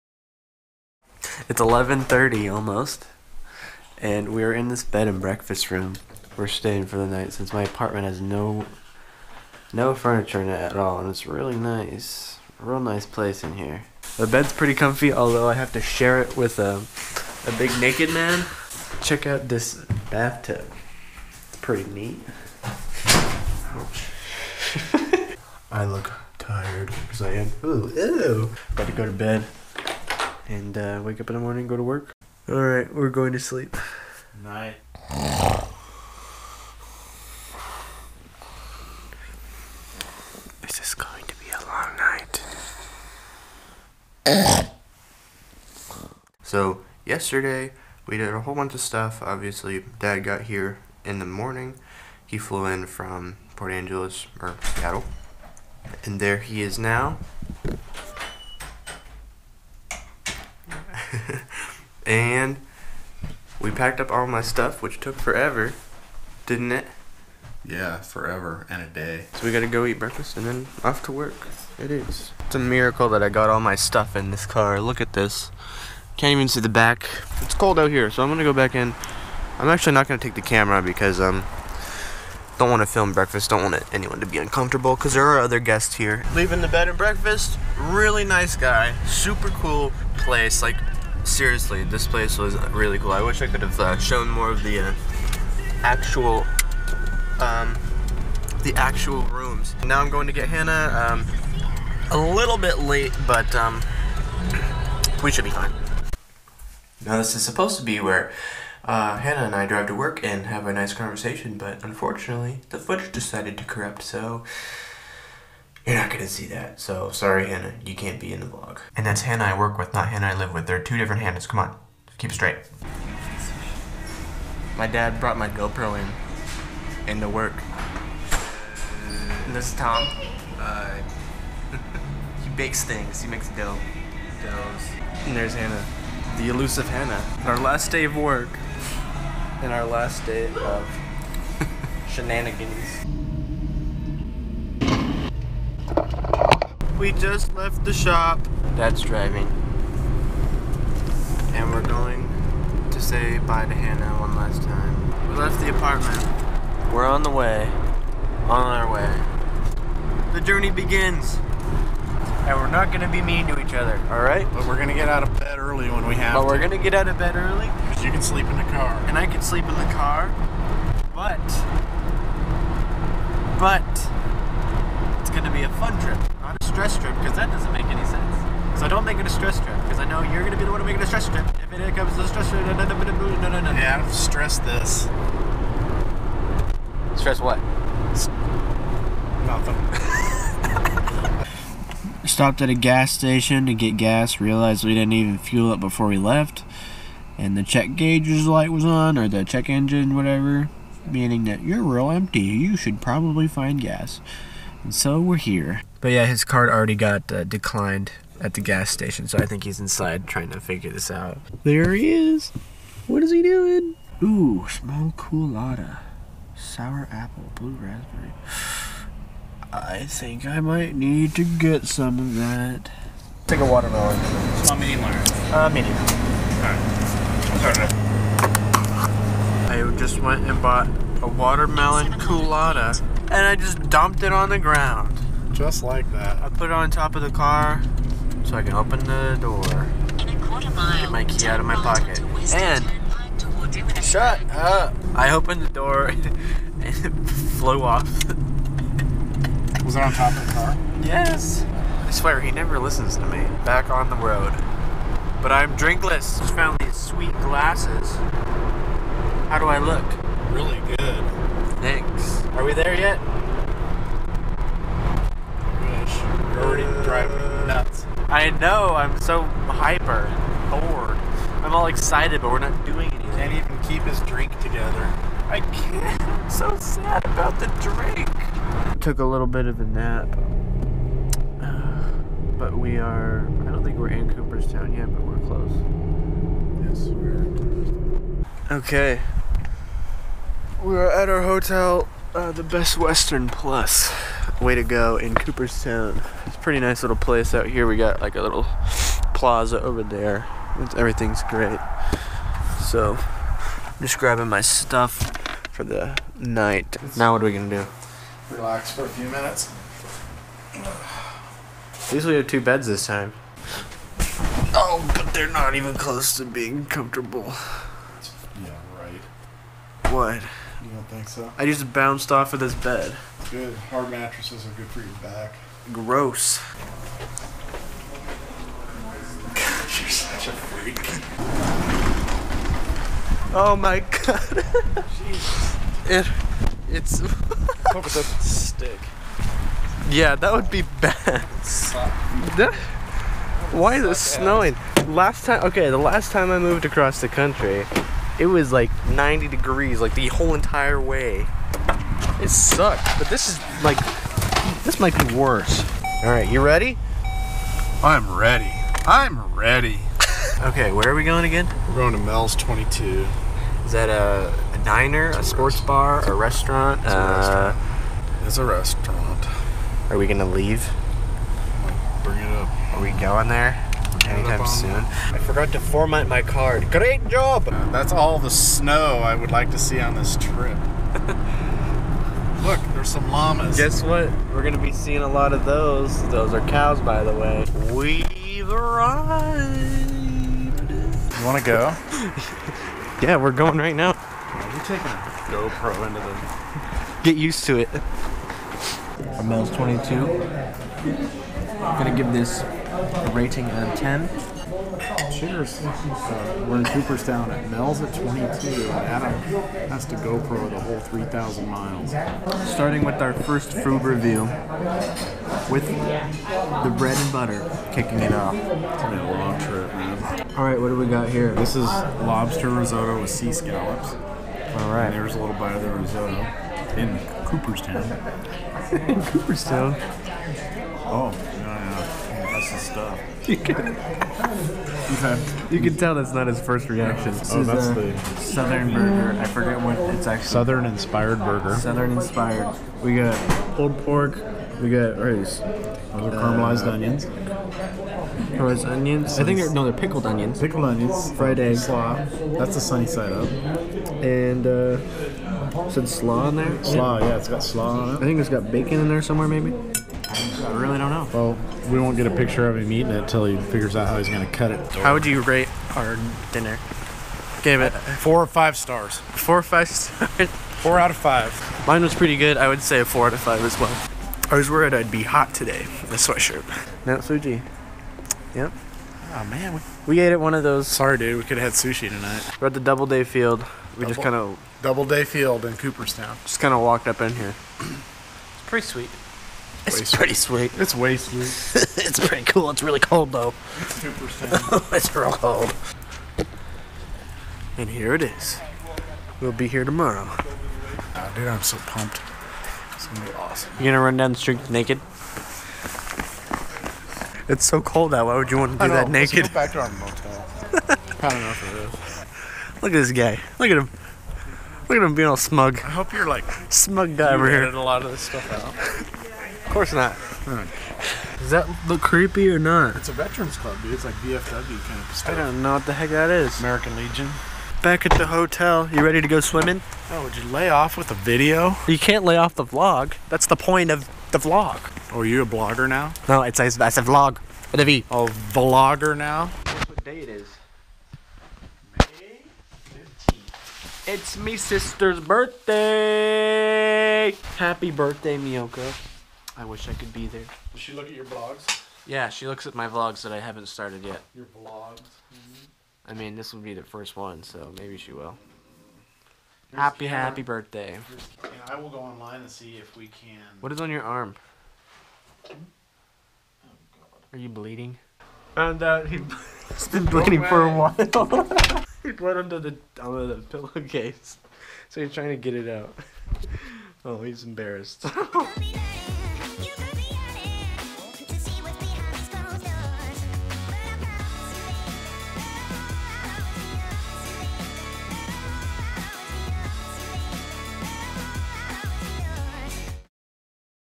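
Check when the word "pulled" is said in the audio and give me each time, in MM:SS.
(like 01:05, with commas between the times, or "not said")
07:23.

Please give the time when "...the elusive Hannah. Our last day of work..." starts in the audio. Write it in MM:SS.
02:16.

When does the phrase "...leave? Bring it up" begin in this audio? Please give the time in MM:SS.
06:10.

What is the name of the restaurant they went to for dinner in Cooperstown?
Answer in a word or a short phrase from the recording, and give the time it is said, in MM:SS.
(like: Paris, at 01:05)
Mel's 22, at 06:02.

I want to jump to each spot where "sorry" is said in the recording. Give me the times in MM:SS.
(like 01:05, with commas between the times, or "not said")
01:57, 08:00.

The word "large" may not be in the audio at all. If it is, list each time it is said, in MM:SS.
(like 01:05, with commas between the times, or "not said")
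03:45.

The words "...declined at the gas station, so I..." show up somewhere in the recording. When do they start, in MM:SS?
03:27.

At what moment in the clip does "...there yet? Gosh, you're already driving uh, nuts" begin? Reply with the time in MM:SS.
04:22.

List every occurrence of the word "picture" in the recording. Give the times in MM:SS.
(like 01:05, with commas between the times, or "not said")
07:42.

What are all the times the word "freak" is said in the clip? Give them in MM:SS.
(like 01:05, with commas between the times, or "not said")
05:30.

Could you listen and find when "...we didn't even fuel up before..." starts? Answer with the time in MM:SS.
03:14.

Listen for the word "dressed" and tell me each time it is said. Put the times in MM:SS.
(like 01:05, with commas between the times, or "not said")
not said.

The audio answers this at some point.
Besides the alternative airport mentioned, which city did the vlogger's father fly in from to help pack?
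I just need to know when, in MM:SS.
00:53.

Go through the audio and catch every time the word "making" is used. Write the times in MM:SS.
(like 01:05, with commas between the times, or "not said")
03:00.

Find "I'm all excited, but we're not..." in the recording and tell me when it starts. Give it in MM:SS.
04:31.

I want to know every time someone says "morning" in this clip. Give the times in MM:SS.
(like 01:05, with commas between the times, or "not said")
00:31, 00:51.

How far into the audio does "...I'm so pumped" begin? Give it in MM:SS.
08:21.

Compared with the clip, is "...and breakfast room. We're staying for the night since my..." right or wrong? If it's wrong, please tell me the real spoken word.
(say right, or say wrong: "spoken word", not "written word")
right.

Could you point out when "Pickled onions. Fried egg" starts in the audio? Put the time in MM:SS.
07:30.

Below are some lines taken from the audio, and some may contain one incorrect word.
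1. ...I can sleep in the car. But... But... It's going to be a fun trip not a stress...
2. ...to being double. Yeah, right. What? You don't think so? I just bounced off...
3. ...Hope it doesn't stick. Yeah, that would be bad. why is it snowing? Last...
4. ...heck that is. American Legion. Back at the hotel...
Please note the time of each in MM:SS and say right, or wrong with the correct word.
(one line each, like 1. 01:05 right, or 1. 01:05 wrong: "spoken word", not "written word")
1. 02:49 right
2. 05:16 wrong: "comfortable", not "double"
3. 05:37 right
4. 08:45 right.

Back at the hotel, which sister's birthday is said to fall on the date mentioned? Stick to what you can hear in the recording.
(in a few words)
Miyoko.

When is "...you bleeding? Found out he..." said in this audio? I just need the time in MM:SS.
09:27.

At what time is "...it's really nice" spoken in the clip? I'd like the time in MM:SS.
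00:11.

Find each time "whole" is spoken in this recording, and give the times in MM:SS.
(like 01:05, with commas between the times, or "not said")
00:48, 05:50, 06:50.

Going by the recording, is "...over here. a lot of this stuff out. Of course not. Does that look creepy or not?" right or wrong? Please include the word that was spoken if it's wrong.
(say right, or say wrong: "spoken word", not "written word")
right.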